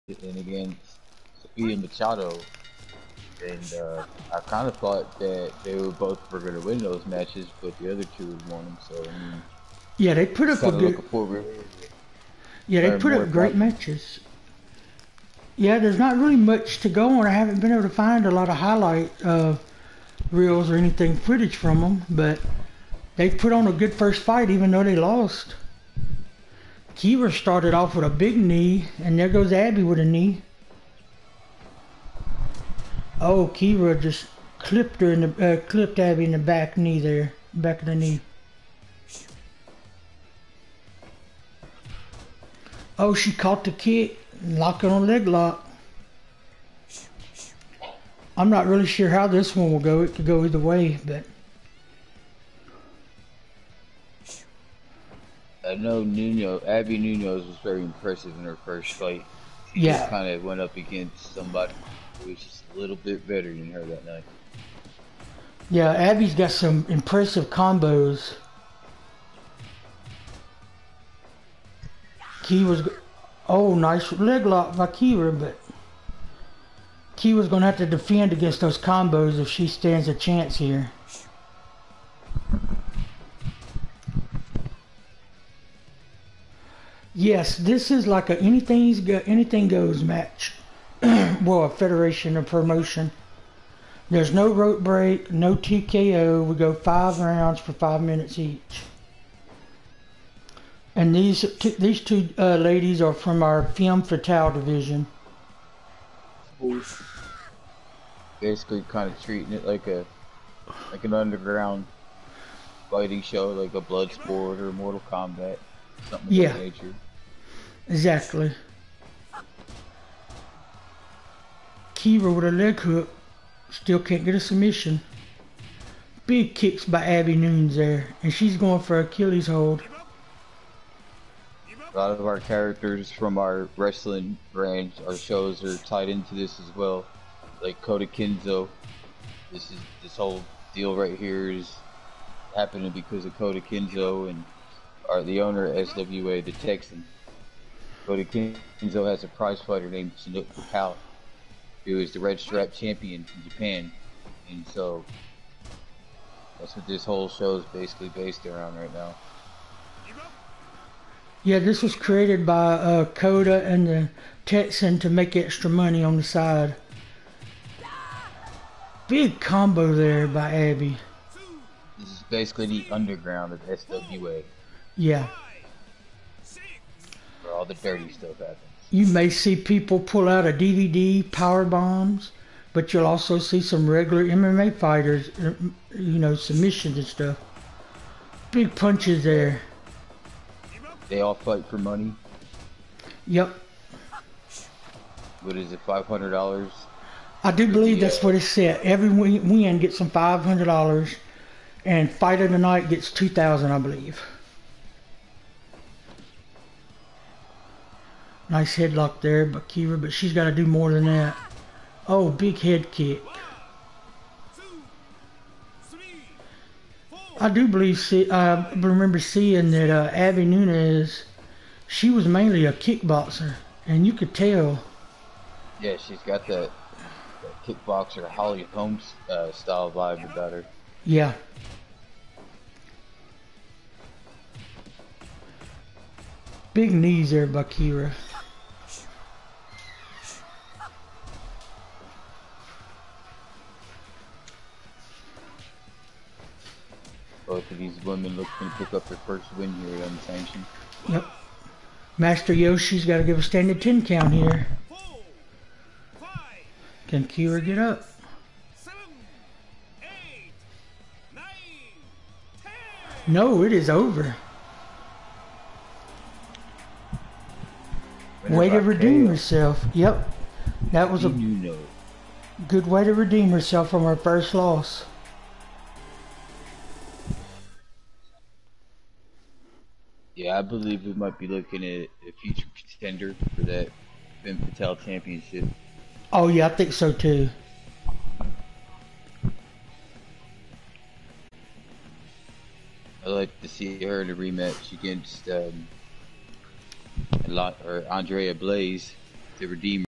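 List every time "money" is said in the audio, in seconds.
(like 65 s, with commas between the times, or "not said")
165 s, 191 s.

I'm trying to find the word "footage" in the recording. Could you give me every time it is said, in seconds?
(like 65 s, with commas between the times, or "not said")
21 s.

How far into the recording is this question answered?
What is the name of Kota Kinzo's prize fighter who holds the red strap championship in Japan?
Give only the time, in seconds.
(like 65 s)
150 s.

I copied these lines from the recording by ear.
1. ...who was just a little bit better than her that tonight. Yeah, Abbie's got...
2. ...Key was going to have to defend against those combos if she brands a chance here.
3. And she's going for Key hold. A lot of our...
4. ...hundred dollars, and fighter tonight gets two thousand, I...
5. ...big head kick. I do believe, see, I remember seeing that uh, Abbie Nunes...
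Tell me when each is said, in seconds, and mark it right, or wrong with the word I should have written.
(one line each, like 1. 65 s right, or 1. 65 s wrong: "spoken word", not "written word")
1. 62 s wrong: "night", not "tonight"
2. 77 s wrong: "stands", not "brands"
3. 128 s wrong: "Achilles", not "Key"
4. 200 s right
5. 212 s right.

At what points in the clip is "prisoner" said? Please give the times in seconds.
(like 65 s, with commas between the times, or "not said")
not said.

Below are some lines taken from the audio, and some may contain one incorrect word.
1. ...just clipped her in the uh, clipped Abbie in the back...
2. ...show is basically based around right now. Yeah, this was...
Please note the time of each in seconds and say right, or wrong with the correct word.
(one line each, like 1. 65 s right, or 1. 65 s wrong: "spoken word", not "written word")
1. 33 s right
2. 157 s right.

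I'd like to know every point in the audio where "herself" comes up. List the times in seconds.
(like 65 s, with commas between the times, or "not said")
269 s, 273 s.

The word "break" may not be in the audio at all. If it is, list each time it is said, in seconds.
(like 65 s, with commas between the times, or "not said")
94 s.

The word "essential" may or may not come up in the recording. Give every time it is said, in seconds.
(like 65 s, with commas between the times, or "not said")
not said.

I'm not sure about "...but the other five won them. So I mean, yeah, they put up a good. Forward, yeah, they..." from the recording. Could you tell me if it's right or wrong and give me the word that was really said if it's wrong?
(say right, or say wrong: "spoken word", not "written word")
wrong: "two", not "five".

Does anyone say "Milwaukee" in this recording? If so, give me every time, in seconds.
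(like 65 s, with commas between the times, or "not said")
not said.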